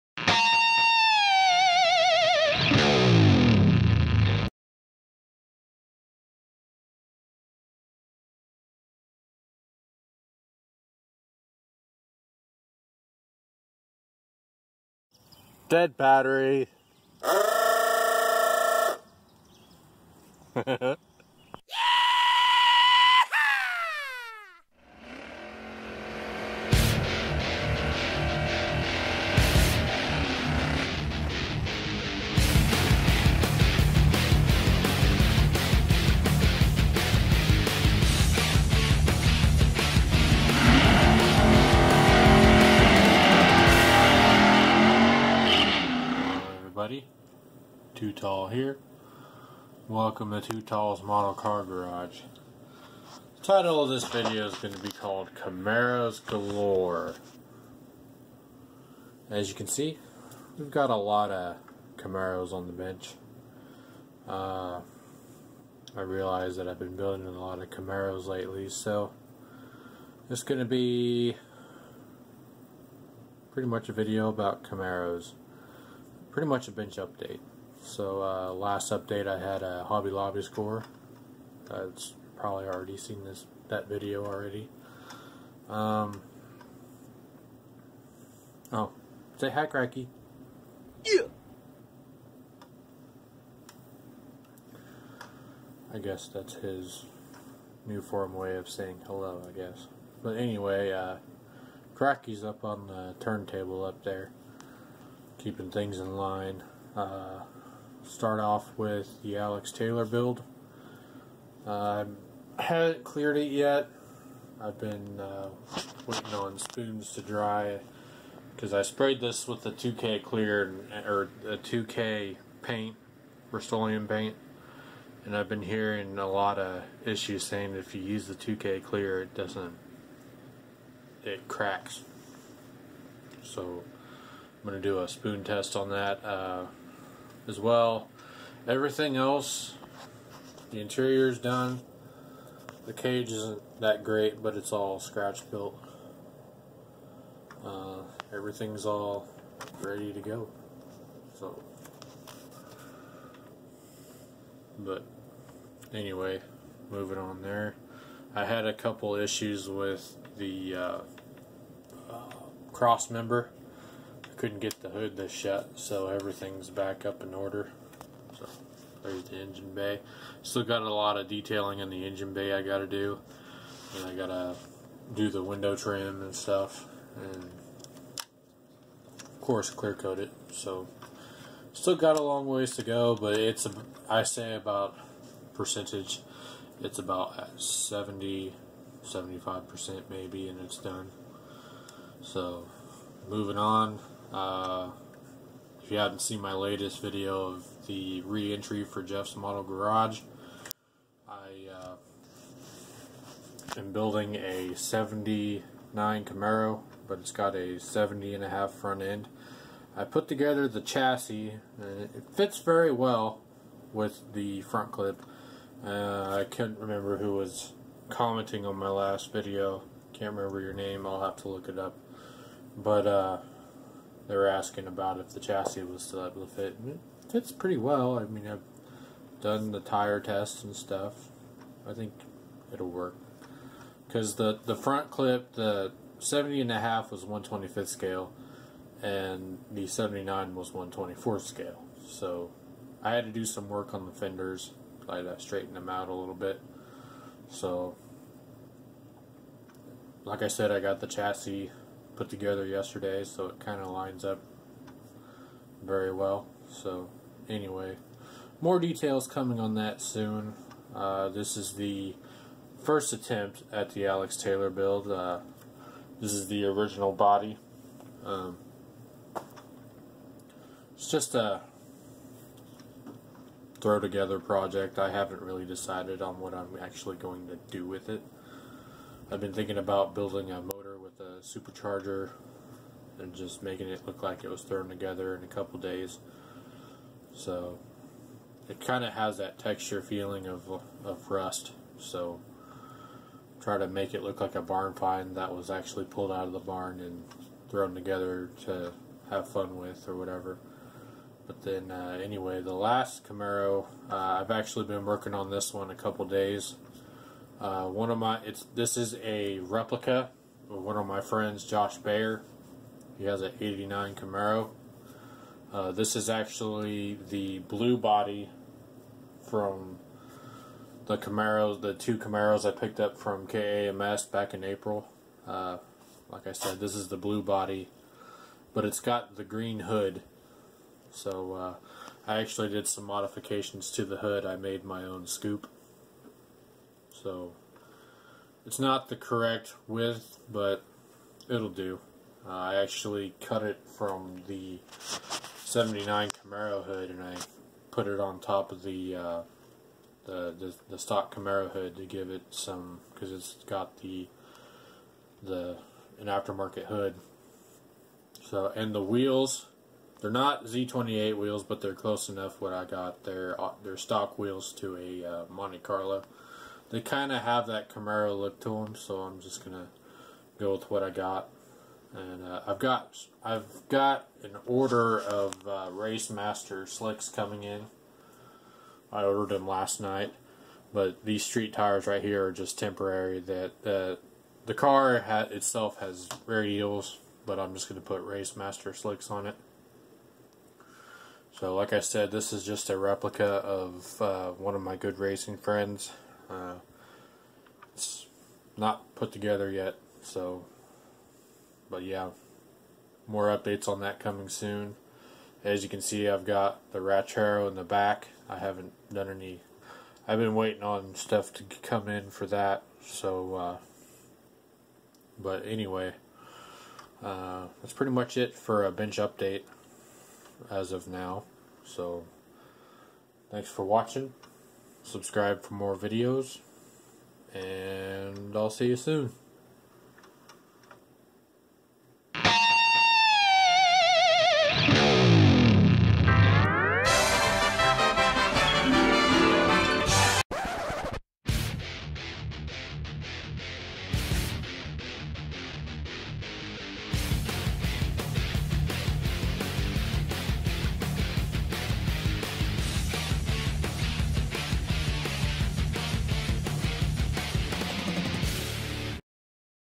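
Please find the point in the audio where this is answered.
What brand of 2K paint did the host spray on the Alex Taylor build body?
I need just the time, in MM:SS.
02:03.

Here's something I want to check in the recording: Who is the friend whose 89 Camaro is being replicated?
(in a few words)
Josh Bayer.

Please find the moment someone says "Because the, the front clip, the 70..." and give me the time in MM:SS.
03:54.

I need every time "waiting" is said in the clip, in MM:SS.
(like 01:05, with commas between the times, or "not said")
01:56, 06:50.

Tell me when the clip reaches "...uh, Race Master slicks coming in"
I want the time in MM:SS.
06:15.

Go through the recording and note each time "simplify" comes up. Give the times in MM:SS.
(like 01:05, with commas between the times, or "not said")
not said.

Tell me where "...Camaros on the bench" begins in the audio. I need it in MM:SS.
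01:01.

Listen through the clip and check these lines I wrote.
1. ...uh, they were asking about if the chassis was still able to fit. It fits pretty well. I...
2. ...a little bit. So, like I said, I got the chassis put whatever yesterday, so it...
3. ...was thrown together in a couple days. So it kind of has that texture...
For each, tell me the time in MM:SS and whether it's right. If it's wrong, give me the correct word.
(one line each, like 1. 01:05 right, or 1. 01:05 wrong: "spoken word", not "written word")
1. 03:43 right
2. 04:06 wrong: "together", not "whatever"
3. 04:44 right.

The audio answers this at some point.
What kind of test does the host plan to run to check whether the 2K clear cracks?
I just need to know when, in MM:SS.
02:15.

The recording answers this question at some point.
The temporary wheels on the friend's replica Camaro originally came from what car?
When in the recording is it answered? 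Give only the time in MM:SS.
06:05.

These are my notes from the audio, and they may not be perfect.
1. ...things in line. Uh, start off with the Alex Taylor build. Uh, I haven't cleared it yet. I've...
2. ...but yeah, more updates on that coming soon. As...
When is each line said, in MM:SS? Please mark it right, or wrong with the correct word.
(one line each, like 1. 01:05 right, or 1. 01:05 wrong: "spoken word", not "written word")
1. 01:45 right
2. 06:41 right.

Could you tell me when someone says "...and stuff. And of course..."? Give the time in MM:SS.
02:56.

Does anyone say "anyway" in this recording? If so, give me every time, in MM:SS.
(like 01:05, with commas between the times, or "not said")
01:40, 02:35, 04:17, 05:02, 06:55.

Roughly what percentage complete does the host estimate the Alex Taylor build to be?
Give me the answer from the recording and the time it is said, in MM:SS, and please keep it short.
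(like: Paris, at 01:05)
70-75%, at 03:07.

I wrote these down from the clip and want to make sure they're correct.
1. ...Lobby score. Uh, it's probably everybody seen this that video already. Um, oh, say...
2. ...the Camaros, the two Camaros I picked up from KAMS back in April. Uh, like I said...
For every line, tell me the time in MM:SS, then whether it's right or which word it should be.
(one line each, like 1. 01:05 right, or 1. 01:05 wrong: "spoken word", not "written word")
1. 01:20 wrong: "already", not "everybody"
2. 05:21 right.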